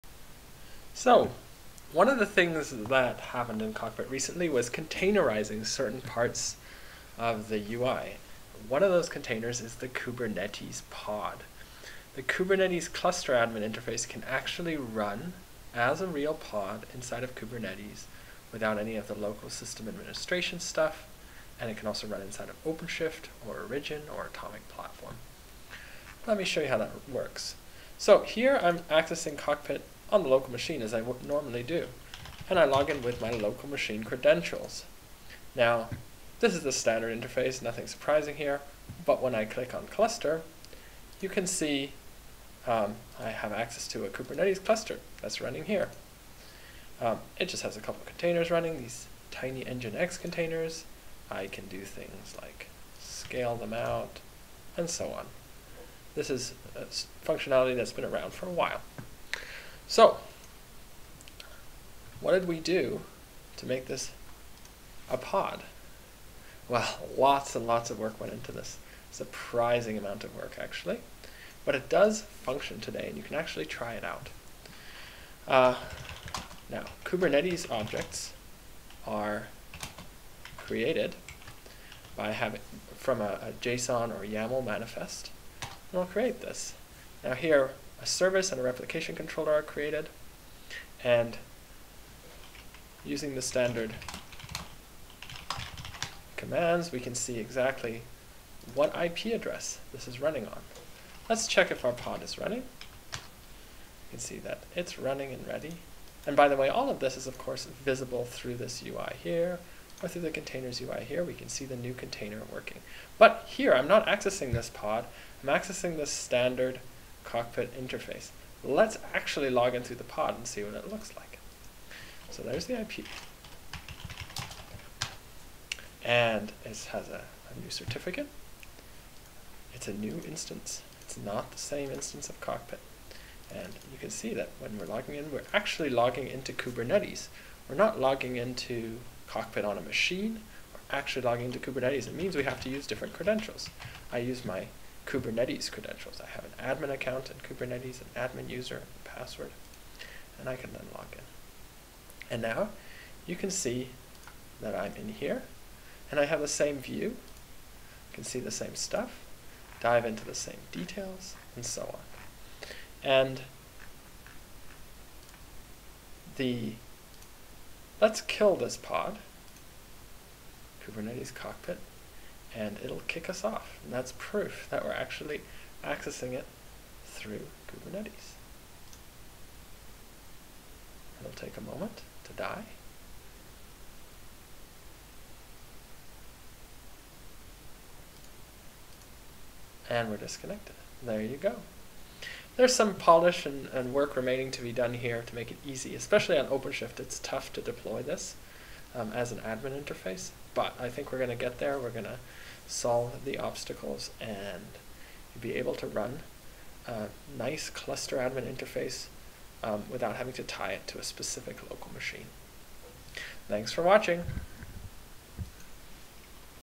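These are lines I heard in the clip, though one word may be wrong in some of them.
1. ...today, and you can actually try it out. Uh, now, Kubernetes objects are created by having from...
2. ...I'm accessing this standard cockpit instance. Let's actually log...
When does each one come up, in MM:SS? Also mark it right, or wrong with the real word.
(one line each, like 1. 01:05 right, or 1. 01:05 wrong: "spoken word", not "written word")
1. 01:12 right
2. 01:55 wrong: "interface", not "instance".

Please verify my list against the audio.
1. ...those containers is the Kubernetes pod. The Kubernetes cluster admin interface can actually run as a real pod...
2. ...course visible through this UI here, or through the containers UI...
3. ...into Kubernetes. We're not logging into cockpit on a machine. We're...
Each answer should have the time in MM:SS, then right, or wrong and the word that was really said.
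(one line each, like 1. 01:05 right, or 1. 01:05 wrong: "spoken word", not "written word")
1. 00:08 right
2. 01:47 right
3. 02:16 right.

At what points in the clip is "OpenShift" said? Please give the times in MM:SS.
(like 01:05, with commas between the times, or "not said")
00:22, 03:16.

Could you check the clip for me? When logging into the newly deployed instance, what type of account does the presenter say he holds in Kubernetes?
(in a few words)
admin account.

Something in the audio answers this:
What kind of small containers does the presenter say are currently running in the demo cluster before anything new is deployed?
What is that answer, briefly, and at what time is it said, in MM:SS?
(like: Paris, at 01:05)
nginx containers, at 00:49.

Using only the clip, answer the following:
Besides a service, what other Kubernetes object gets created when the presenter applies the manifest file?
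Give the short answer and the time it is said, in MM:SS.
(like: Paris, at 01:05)
replication controller, at 01:28.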